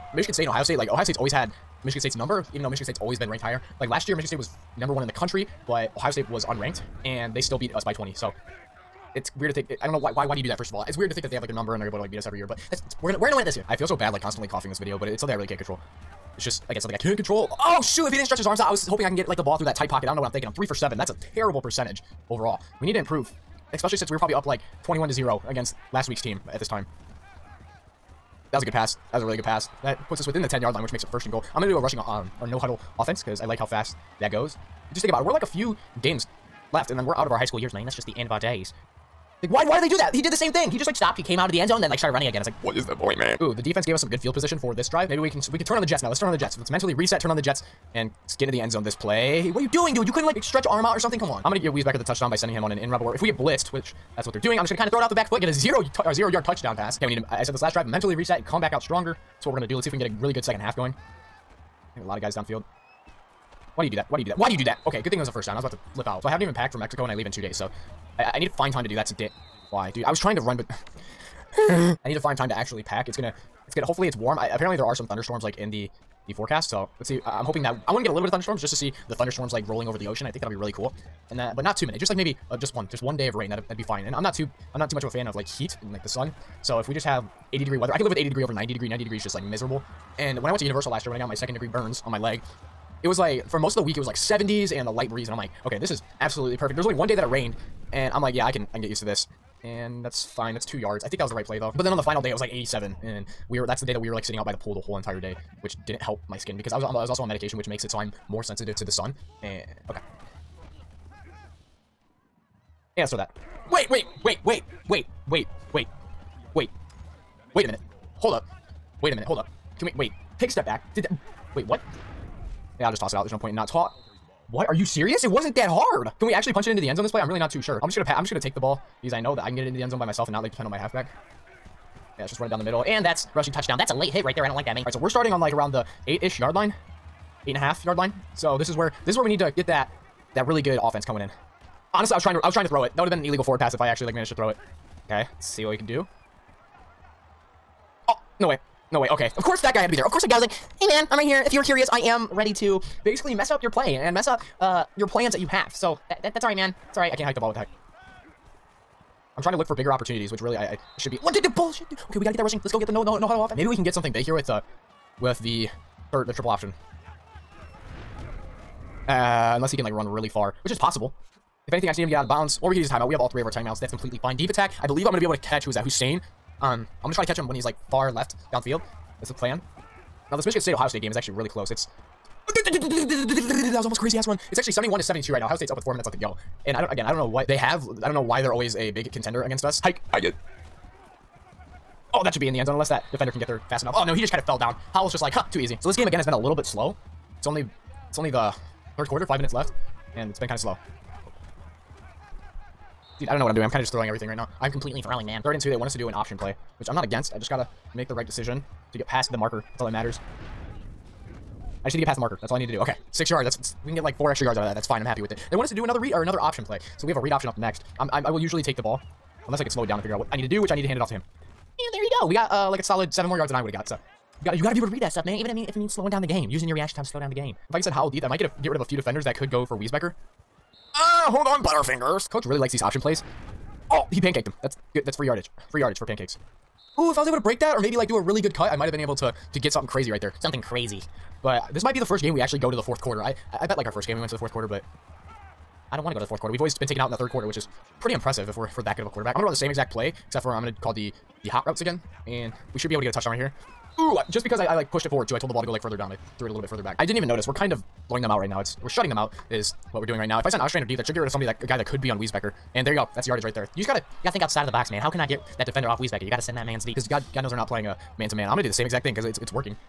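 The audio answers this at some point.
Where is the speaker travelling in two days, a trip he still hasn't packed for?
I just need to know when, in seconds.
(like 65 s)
66 s.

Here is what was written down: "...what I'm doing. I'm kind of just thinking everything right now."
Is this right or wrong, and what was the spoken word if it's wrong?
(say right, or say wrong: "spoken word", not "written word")
wrong: "throwing", not "thinking".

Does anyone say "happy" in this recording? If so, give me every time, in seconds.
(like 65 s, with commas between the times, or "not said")
215 s.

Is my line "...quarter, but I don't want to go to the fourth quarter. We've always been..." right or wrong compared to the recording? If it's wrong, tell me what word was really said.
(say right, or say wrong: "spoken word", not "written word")
right.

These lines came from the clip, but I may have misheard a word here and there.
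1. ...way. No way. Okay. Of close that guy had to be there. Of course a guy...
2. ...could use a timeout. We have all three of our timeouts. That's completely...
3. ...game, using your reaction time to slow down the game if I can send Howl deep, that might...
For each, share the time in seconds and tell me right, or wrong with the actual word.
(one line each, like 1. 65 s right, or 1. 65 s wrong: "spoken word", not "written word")
1. 148 s wrong: "course", not "close"
2. 172 s right
3. 226 s right.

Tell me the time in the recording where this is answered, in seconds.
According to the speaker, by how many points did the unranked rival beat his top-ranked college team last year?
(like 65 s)
7 s.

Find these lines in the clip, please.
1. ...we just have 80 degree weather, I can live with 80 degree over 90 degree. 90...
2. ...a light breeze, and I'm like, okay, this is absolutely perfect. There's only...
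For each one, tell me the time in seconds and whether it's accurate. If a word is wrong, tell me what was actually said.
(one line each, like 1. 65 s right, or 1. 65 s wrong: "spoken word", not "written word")
1. 86 s right
2. 94 s right.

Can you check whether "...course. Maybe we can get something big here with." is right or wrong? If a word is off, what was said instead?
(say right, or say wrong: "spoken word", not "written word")
wrong: "offense", not "course".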